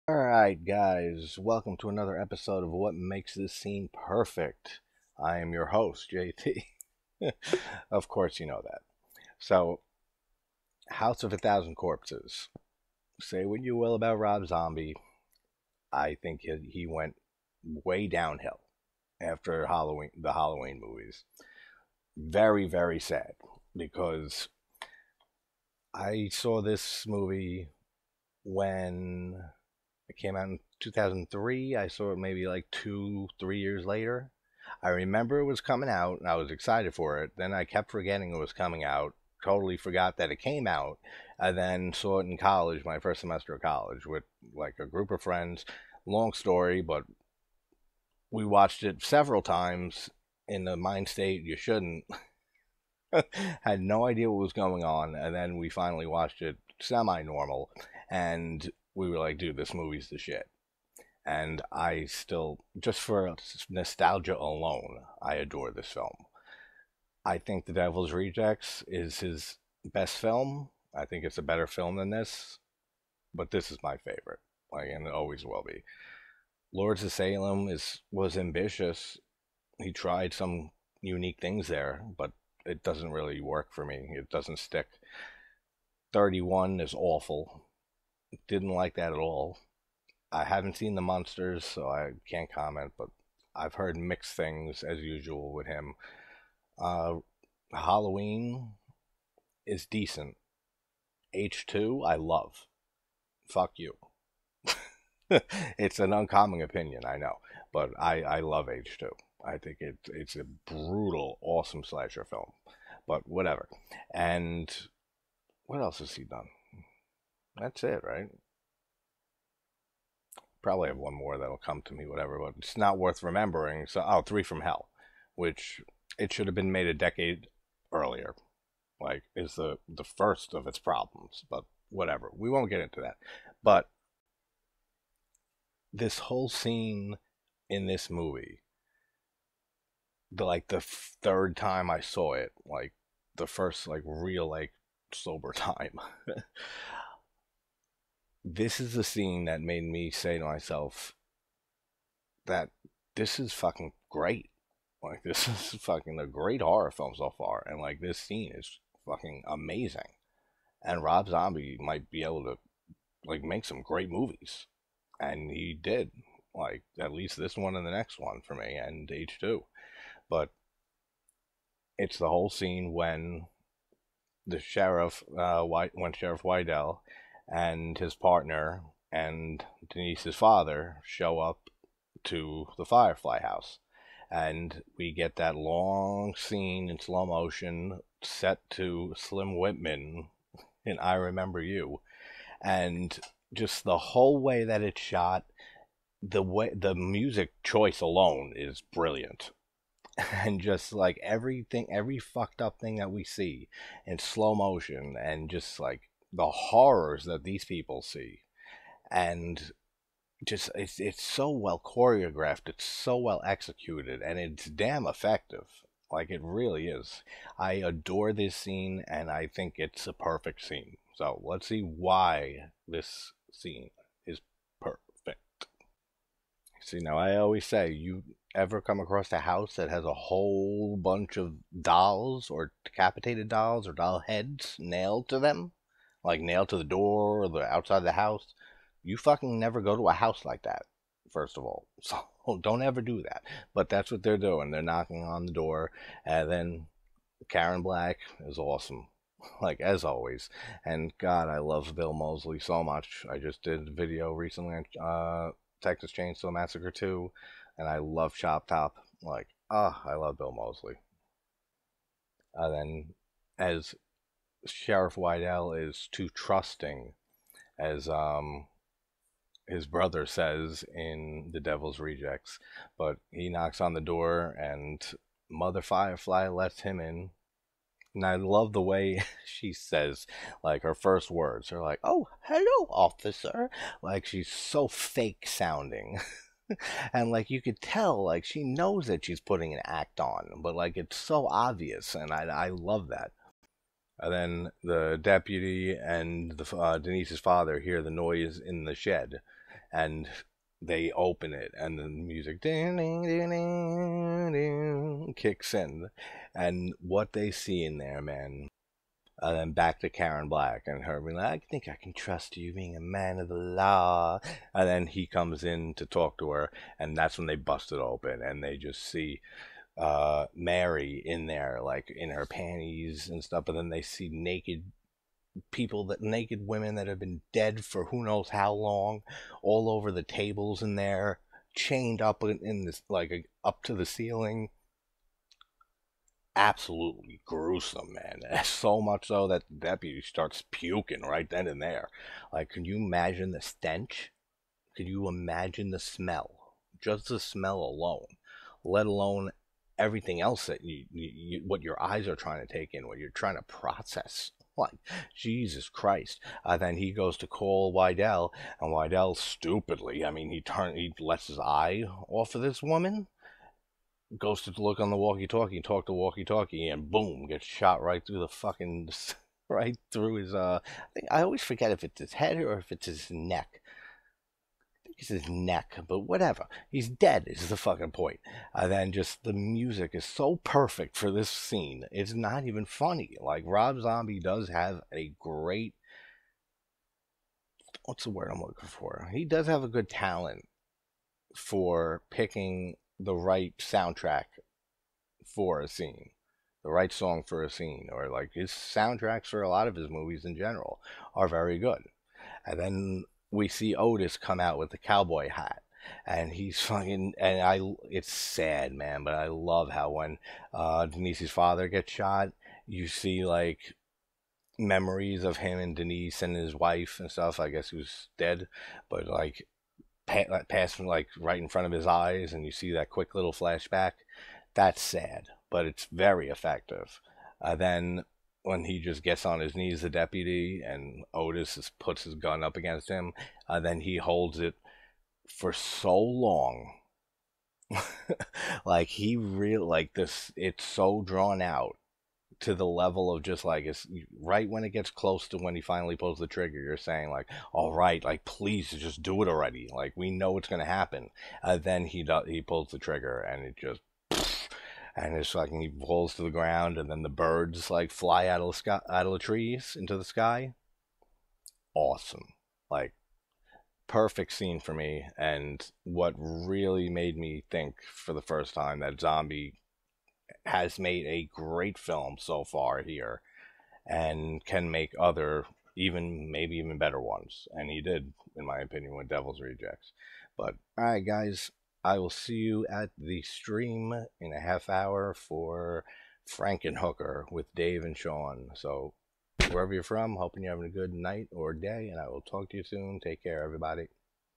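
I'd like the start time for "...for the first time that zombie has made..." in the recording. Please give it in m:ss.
7:48.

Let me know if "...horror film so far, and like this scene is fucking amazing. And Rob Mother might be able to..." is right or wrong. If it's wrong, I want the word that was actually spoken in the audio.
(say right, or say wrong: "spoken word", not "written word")
wrong: "Zombie", not "Mother".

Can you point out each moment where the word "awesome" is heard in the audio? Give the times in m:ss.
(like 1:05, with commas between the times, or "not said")
1:51, 4:08, 7:41.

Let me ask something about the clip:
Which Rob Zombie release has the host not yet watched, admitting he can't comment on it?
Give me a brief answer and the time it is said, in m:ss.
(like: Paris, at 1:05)
The Munsters, at 1:31.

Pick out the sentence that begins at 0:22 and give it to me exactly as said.
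Very, very sad because I saw this movie when it came out in 2003.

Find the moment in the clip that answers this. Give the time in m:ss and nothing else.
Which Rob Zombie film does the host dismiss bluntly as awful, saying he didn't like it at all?
1:26.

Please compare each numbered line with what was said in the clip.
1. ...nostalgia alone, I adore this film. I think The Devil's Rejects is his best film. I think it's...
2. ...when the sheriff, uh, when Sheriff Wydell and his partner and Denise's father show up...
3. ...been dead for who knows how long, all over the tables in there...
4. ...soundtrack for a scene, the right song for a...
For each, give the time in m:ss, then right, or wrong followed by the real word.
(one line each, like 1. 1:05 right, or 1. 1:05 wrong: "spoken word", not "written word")
1. 1:03 right
2. 2:52 right
3. 5:27 right
4. 6:33 right.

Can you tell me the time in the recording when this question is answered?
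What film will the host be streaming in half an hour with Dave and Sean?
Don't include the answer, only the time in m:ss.
8:06.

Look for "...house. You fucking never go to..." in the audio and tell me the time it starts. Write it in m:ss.
3:58.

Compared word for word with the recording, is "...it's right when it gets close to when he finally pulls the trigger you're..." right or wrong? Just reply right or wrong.
right.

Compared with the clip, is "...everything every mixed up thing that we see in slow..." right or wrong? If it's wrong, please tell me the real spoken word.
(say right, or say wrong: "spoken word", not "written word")
wrong: "fucked", not "mixed".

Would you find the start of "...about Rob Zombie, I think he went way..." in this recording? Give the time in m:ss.
0:13.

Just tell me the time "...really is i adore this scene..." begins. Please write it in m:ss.
3:36.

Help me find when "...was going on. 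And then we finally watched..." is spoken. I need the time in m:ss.
0:54.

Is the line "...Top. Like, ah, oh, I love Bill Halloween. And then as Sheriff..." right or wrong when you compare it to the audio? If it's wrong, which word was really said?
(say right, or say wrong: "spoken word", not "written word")
wrong: "Moseley", not "Halloween".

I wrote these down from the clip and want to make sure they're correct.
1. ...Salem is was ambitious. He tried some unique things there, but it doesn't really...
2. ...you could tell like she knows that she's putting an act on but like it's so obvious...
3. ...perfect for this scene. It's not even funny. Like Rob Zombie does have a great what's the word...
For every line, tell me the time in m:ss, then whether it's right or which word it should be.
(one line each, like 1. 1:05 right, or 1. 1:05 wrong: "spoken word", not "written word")
1. 1:17 right
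2. 4:47 right
3. 6:20 right.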